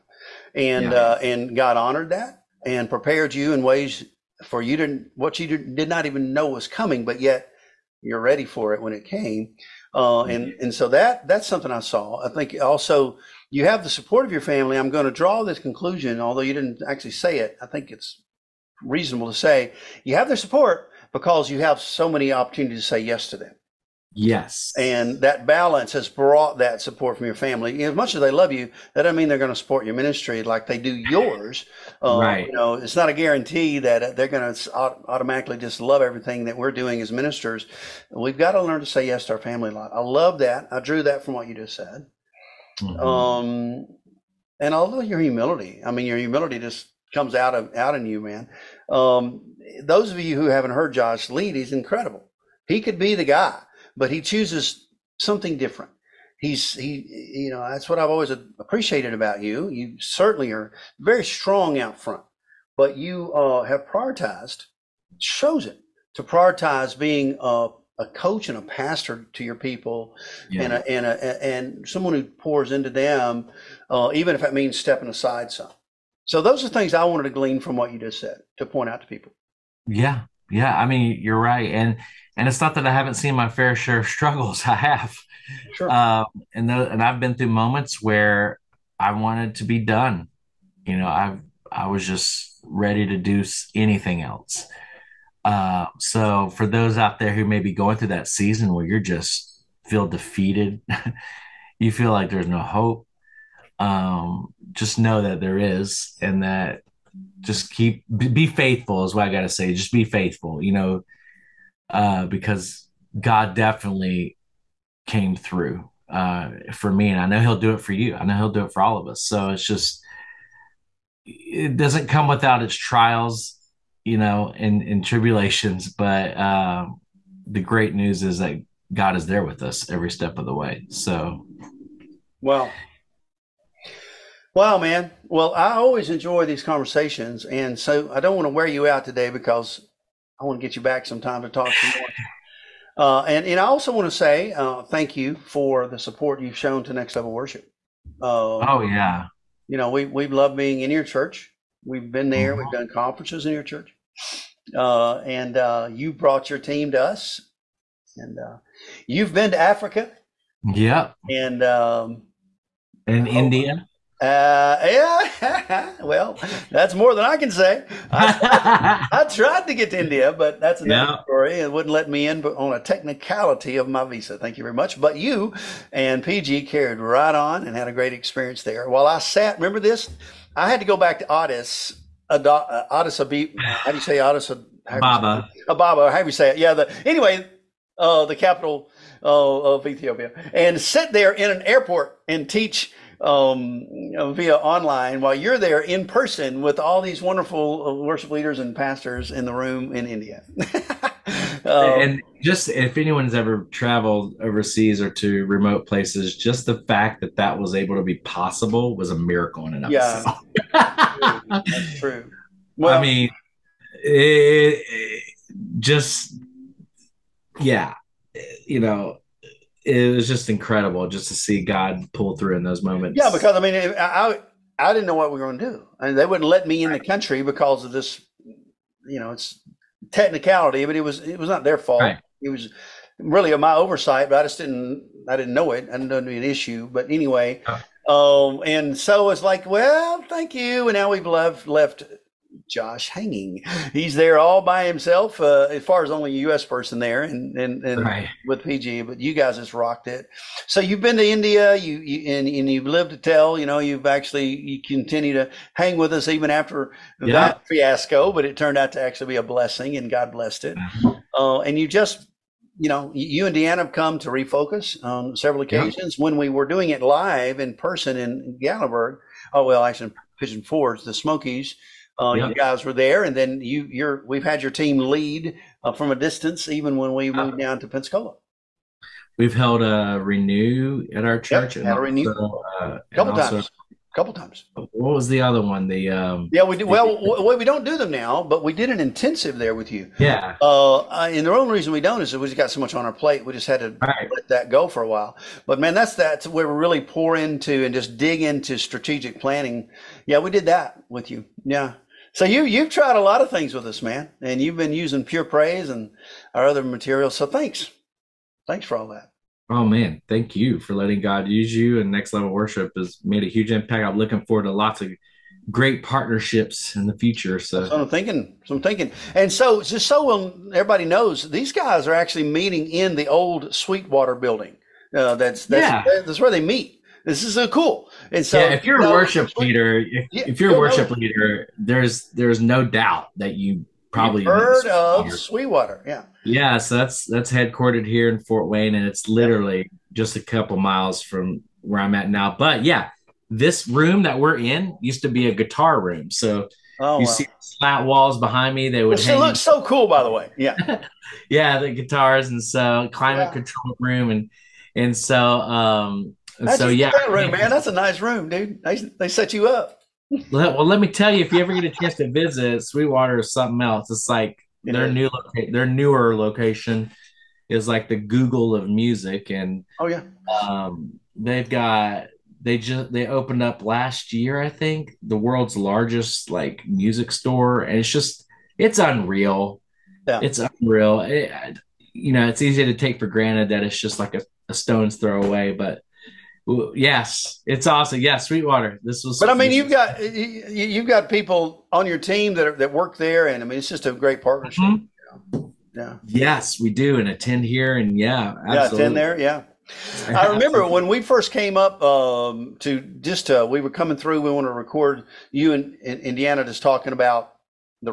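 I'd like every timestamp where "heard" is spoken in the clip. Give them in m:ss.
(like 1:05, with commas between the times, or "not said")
0:50, 5:34.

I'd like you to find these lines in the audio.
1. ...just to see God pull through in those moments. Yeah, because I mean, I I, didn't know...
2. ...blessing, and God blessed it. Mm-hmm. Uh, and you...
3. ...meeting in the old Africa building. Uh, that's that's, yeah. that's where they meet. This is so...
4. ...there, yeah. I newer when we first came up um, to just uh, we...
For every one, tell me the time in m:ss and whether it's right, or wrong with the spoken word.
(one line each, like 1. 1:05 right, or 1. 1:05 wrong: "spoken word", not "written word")
1. 3:41 right
2. 4:19 right
3. 5:22 wrong: "Sweetwater", not "Africa"
4. 6:39 wrong: "remember", not "newer".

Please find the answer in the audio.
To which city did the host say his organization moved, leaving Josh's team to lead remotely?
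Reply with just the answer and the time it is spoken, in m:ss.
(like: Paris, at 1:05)
Pensacola, at 4:37.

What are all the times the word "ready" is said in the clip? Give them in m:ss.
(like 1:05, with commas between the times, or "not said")
0:08, 1:32.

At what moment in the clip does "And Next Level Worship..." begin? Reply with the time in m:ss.
5:11.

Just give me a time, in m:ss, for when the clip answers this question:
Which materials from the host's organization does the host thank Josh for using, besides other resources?
5:05.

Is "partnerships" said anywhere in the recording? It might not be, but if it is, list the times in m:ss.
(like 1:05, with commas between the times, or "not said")
5:16, 6:34.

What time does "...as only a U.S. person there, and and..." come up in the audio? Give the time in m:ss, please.
4:06.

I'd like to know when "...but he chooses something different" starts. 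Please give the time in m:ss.
0:53.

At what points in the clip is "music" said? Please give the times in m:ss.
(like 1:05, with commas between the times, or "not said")
6:08, 6:16.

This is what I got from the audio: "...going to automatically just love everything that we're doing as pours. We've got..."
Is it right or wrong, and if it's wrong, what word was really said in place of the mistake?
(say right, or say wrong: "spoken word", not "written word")
wrong: "ministers", not "pours".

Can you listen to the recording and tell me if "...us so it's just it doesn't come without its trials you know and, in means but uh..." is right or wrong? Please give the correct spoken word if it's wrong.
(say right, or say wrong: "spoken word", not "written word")
wrong: "tribulations", not "means".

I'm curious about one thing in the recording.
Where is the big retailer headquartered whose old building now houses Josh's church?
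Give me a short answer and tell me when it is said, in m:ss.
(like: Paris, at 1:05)
Fort Wayne, at 5:38.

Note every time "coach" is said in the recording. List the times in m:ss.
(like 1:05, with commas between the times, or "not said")
1:08.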